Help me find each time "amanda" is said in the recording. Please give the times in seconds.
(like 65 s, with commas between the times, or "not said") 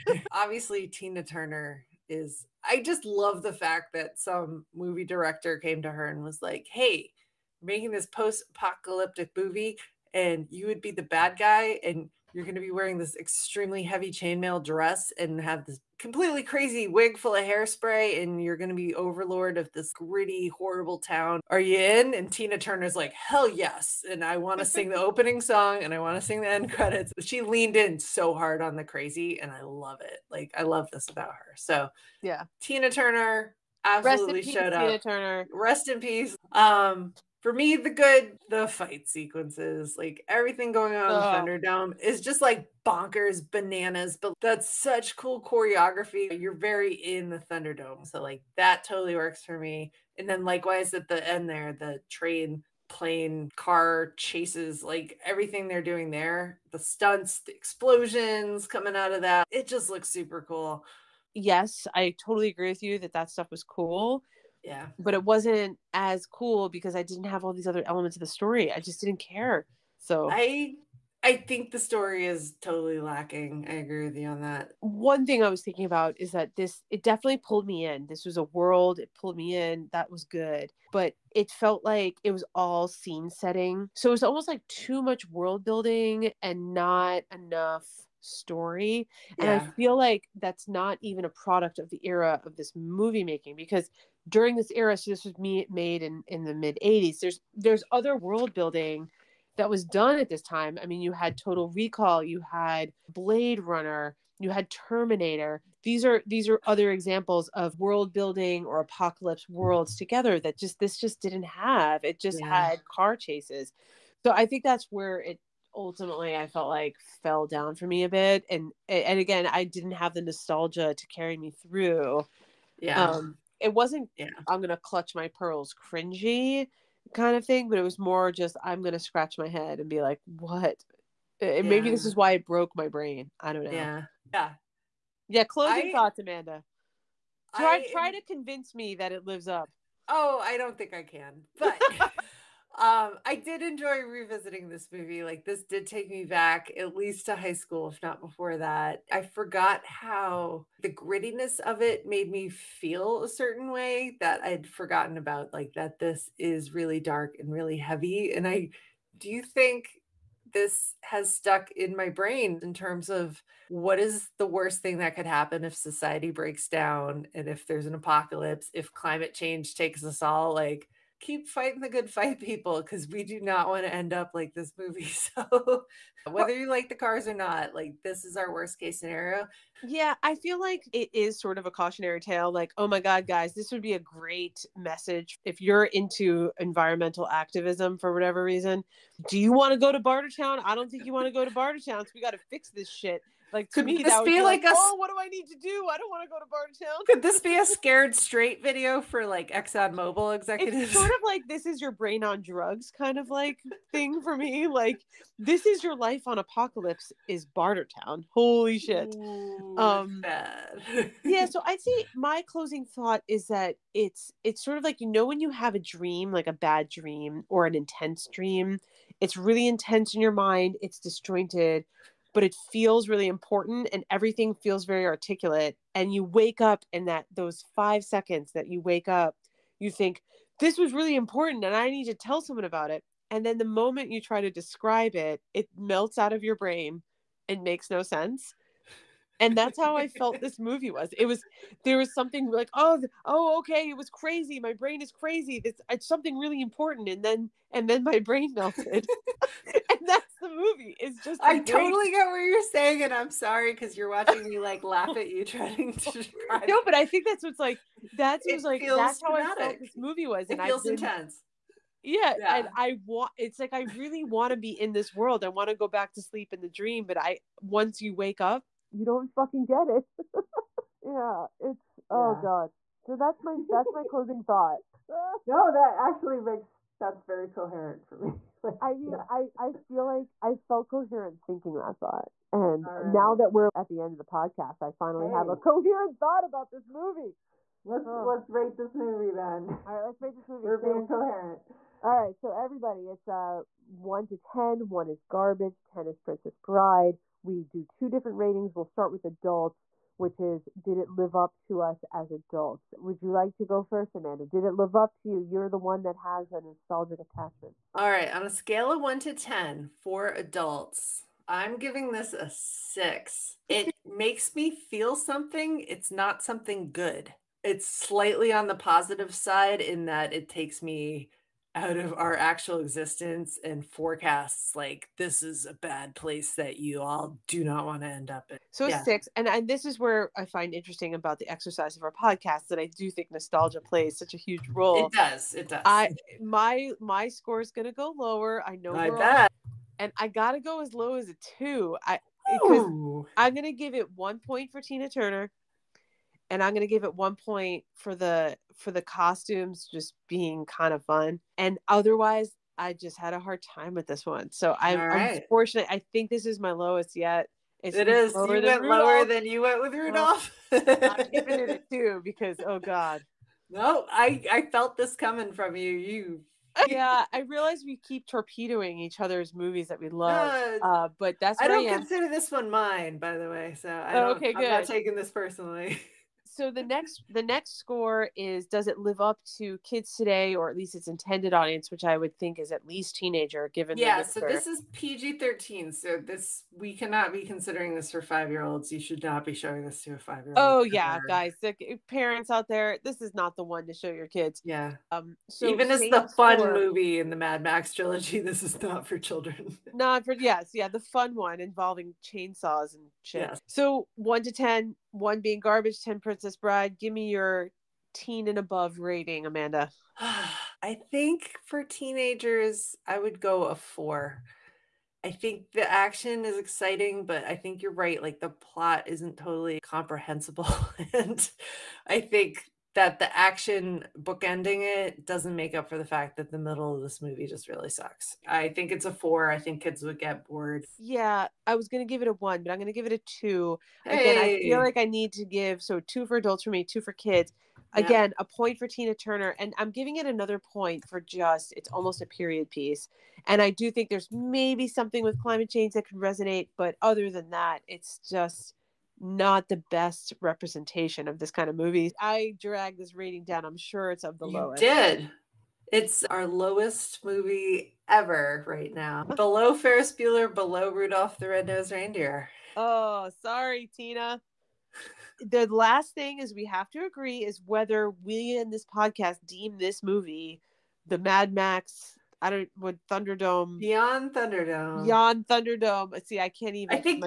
136 s, 304 s, 409 s.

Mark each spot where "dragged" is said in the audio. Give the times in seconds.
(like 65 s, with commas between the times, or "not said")
452 s.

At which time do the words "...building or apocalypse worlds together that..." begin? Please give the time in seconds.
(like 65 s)
108 s.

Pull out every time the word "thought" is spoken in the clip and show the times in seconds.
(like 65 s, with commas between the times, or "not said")
135 s, 212 s, 274 s, 281 s, 286 s.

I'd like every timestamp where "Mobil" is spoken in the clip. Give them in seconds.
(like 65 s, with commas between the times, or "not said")
199 s.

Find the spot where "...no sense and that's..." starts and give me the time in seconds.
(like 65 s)
237 s.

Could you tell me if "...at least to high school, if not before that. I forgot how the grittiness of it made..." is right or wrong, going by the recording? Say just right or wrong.
right.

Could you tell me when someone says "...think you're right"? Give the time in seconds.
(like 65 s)
417 s.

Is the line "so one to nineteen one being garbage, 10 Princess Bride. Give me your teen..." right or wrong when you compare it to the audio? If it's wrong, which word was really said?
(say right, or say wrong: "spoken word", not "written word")
wrong: "ten", not "nineteen".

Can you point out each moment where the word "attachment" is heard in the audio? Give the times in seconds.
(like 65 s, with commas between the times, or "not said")
307 s.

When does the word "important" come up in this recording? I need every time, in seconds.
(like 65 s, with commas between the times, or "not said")
223 s, 231 s, 246 s.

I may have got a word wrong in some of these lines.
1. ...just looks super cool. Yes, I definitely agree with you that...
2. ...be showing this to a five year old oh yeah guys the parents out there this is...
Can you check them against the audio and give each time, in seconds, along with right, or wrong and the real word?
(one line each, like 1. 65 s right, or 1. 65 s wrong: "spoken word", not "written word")
1. 59 s wrong: "totally", not "definitely"
2. 389 s right.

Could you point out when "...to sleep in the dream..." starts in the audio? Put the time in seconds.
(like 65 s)
266 s.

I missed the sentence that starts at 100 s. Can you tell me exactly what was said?
I mean, you had Total Recall, you had Blade Runner, you had Terminator.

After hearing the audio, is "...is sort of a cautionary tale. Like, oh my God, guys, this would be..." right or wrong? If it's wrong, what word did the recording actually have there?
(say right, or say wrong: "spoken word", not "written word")
right.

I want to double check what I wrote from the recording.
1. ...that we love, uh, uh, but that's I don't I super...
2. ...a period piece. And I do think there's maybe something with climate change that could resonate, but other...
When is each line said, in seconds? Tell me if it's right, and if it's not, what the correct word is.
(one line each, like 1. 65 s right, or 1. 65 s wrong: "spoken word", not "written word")
1. 369 s wrong: "consider", not "super"
2. 442 s right.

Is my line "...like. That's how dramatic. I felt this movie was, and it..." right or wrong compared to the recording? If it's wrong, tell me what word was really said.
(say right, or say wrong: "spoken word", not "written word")
right.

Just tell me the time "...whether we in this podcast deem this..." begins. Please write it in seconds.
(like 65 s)
467 s.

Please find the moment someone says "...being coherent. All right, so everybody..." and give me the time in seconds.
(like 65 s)
290 s.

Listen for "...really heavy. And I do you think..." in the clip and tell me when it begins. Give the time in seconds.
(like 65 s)
157 s.